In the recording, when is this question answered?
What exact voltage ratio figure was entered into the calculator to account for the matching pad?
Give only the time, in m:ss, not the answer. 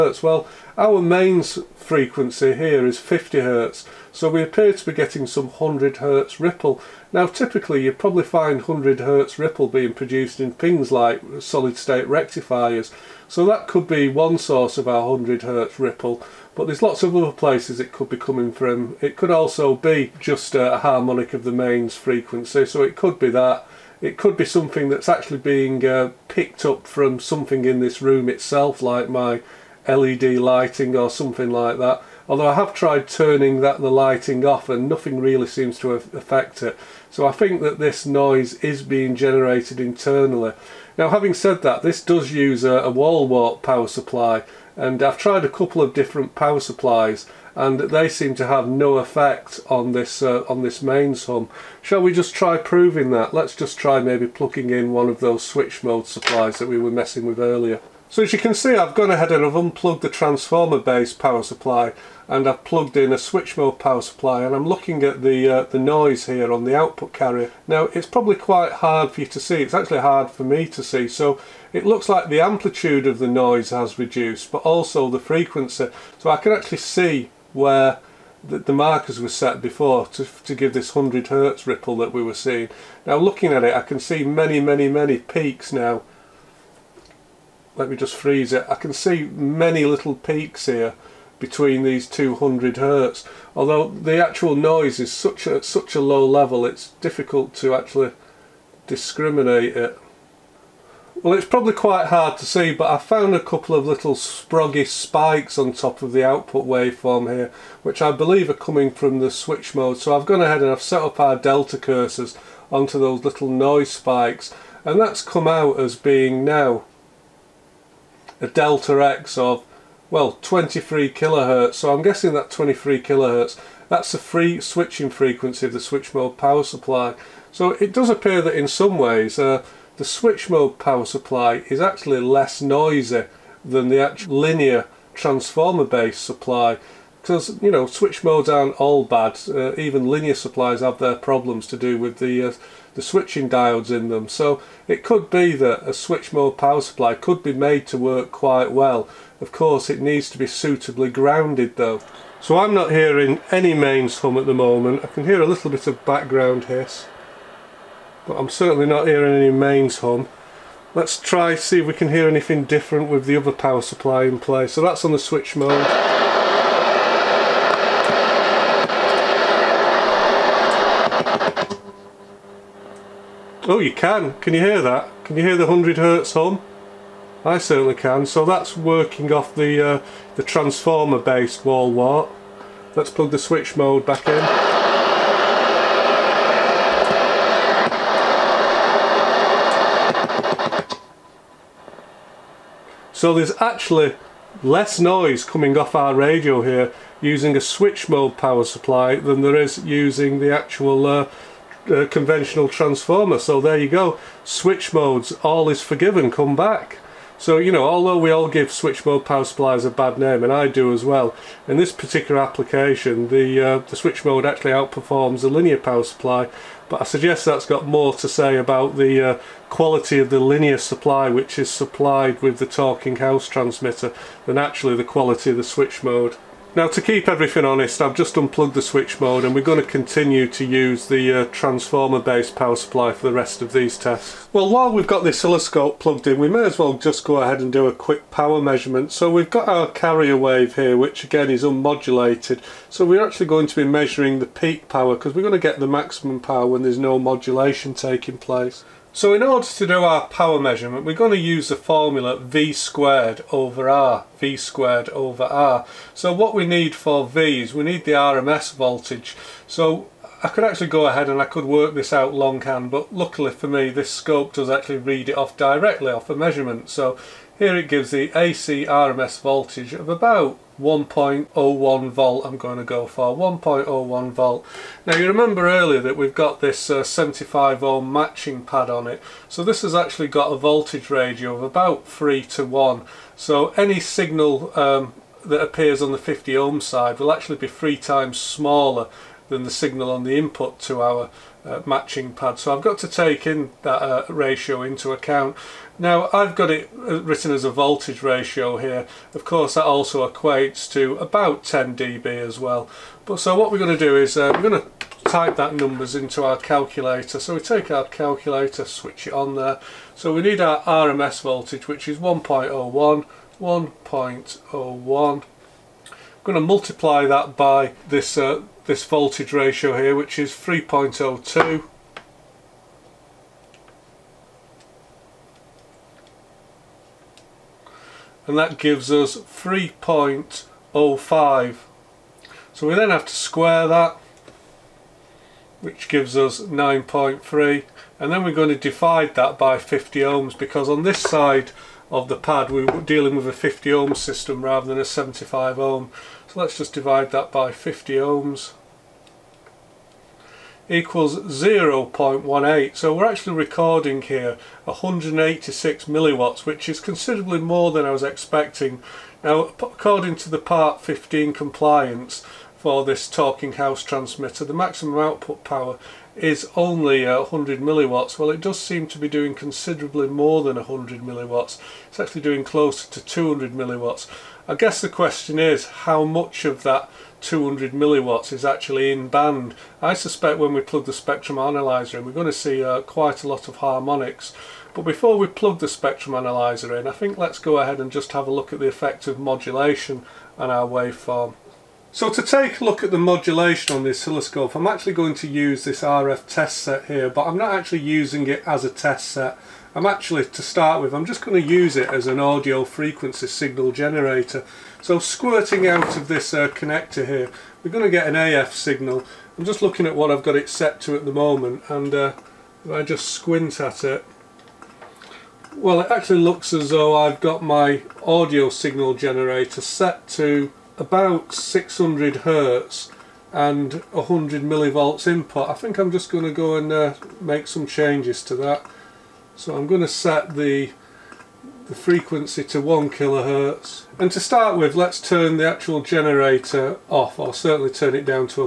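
5:20.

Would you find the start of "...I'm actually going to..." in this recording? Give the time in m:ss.
6:34.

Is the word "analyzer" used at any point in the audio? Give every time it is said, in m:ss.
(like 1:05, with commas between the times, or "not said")
6:21, 6:26.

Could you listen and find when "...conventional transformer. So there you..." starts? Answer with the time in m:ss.
3:22.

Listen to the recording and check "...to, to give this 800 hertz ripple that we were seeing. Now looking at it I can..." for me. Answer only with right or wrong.
wrong.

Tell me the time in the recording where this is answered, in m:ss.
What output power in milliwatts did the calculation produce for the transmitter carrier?
5:54.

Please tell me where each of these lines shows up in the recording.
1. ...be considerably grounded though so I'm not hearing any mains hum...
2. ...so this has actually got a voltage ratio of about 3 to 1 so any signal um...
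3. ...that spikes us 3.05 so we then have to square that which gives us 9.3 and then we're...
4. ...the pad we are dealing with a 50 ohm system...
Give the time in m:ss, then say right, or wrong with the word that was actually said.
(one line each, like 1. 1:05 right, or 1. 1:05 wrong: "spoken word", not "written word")
1. 2:30 wrong: "suitably", not "considerably"
2. 4:39 right
3. 5:28 wrong: "gives", not "spikes"
4. 5:42 right.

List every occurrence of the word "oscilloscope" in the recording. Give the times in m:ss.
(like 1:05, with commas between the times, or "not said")
3:55, 6:34.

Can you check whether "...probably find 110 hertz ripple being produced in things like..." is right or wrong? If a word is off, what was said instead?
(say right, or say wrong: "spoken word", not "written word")
wrong: "100", not "110".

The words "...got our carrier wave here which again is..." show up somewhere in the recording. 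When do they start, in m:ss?
3:59.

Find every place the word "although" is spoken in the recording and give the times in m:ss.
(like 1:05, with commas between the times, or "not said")
0:32, 1:33, 3:27.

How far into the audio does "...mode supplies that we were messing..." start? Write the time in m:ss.
0:55.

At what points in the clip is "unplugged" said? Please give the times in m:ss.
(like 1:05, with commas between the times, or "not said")
0:59, 3:48.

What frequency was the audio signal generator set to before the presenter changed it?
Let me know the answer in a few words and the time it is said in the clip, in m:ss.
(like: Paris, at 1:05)
600 Hz, at 7:01.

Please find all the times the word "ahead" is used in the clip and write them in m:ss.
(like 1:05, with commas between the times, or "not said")
0:59, 1:50, 3:57, 4:21, 6:27.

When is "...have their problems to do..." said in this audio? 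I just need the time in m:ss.
2:20.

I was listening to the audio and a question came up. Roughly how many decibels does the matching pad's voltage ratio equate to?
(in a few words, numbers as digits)
10 dB.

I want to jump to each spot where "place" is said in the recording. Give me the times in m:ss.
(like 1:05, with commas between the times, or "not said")
0:17, 2:44, 4:08.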